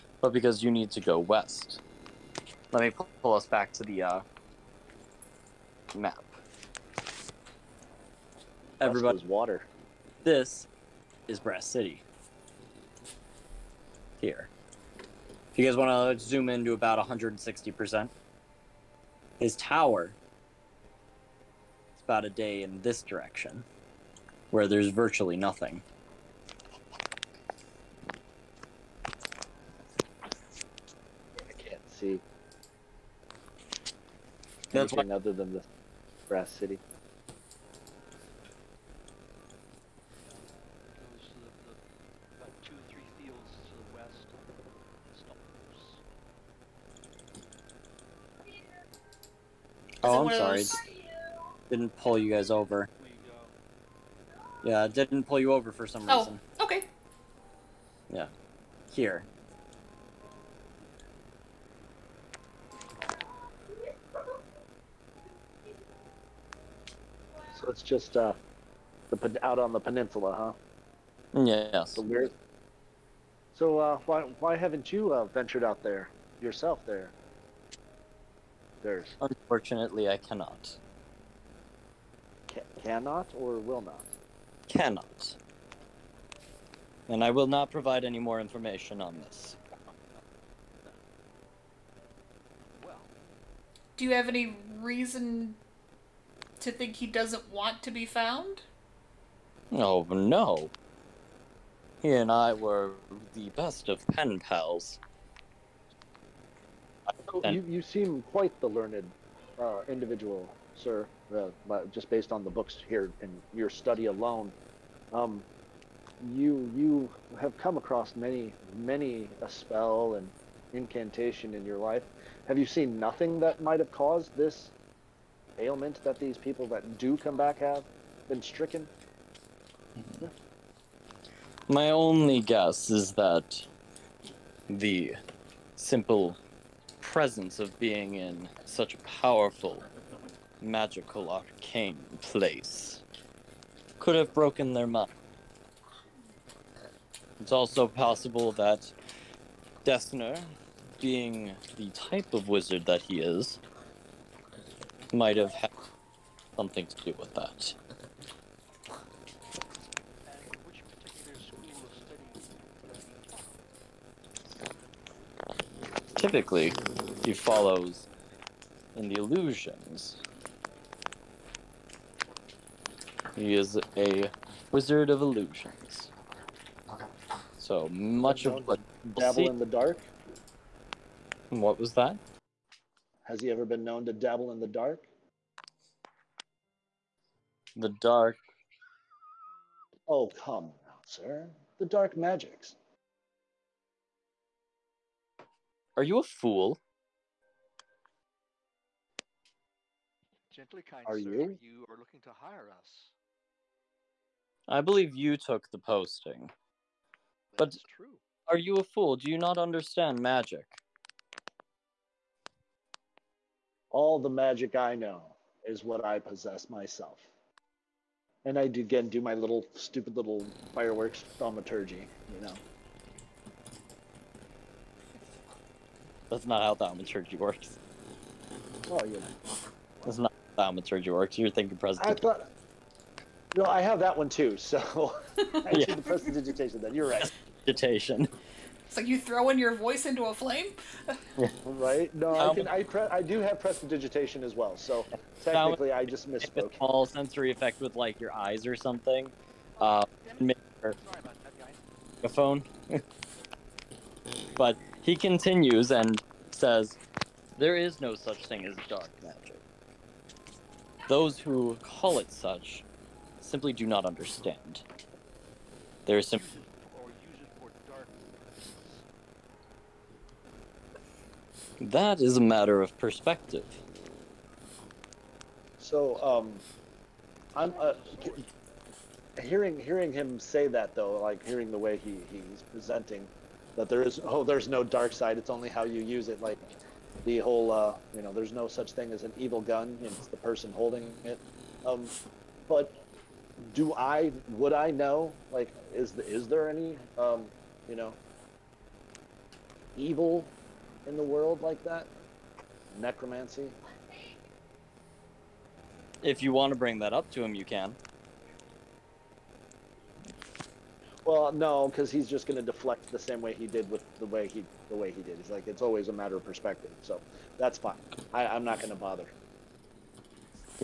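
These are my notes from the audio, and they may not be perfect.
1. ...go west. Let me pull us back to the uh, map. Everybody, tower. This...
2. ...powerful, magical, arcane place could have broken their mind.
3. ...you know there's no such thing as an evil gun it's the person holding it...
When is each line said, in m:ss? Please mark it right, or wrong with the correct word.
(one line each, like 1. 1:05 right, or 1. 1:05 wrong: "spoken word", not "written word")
1. 0:00 wrong: "water", not "tower"
2. 2:18 right
3. 4:48 right.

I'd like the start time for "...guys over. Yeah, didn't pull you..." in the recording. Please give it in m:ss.
0:52.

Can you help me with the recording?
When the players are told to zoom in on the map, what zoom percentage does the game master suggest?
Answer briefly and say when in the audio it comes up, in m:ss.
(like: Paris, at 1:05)
160%, at 0:17.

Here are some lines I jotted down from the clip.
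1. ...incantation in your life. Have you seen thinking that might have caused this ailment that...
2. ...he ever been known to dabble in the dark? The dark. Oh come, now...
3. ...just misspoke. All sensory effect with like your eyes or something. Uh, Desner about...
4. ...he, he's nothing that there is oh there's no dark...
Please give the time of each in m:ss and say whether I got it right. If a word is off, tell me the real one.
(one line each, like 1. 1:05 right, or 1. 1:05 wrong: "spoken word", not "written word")
1. 2:00 wrong: "nothing", not "thinking"
2. 3:03 right
3. 4:06 wrong: "Sorry", not "Desner"
4. 4:42 wrong: "presenting", not "nothing".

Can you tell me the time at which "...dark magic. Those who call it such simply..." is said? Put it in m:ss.
4:18.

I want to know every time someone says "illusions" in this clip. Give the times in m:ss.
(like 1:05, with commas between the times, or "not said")
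2:49, 2:55.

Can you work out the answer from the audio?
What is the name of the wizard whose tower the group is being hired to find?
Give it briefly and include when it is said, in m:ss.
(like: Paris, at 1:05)
Desner, at 2:29.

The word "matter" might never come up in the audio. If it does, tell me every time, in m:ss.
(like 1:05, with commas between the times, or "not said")
4:32, 5:16.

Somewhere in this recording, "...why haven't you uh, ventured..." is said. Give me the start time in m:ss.
1:14.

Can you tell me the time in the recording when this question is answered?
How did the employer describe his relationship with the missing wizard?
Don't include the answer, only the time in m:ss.
1:43.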